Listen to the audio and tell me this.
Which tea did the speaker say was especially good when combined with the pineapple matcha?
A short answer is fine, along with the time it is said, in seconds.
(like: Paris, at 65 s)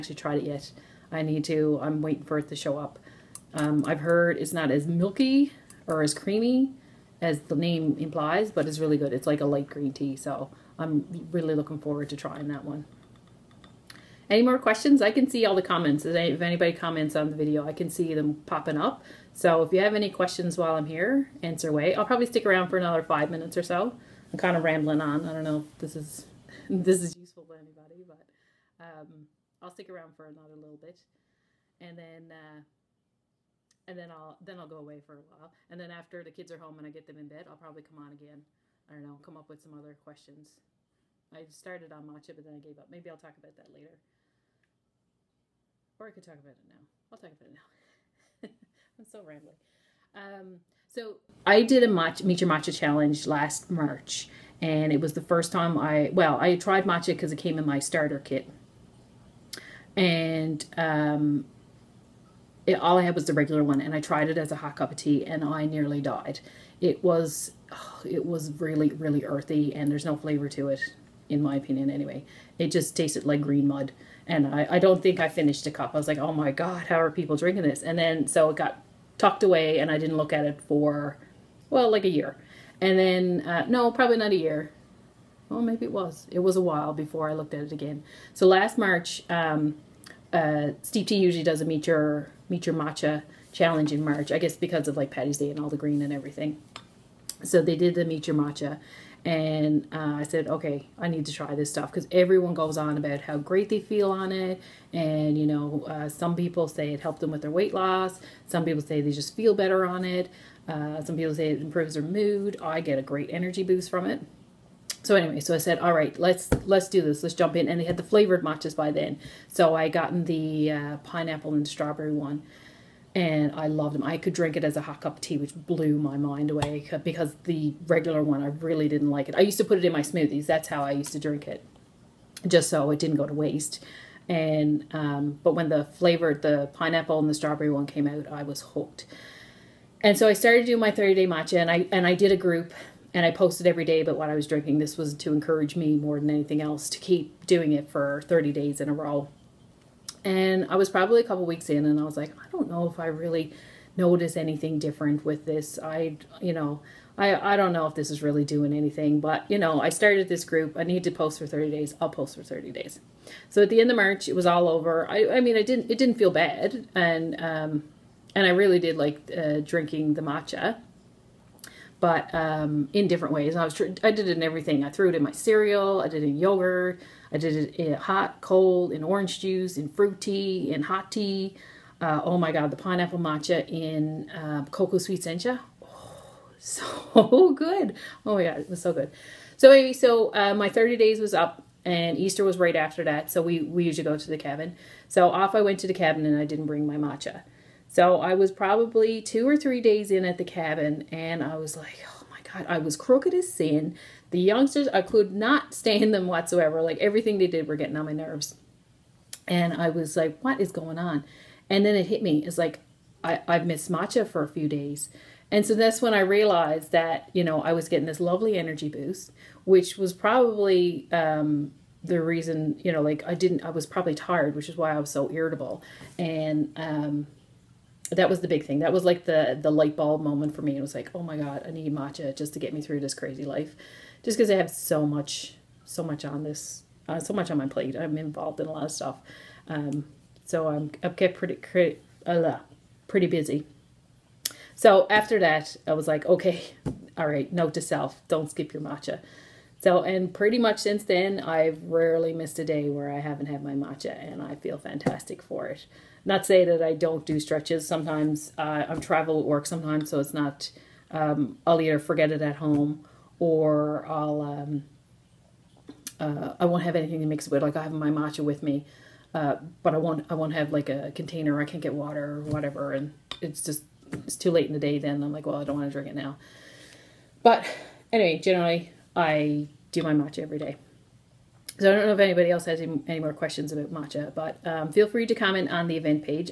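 cocoa sweet sencha, at 184 s.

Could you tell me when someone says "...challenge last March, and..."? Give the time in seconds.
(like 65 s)
52 s.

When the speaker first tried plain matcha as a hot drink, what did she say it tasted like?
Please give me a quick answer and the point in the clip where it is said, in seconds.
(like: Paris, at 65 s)
green mud, at 73 s.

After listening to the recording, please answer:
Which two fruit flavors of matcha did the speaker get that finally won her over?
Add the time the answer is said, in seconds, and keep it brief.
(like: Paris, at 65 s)
pineapple and strawberry, at 120 s.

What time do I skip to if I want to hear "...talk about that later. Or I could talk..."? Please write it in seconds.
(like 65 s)
43 s.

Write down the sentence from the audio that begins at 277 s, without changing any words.
But anyway, generally I do my matcha every day.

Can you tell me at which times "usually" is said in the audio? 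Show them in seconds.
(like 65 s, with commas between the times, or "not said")
90 s, 193 s.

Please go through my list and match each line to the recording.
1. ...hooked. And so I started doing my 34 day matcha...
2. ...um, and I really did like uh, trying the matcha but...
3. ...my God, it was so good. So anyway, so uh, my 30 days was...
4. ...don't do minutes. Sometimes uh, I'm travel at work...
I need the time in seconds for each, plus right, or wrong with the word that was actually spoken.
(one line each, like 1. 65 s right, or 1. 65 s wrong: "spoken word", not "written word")
1. 138 s wrong: "30", not "34"
2. 167 s wrong: "drinking", not "trying"
3. 188 s right
4. 256 s wrong: "stretches", not "minutes".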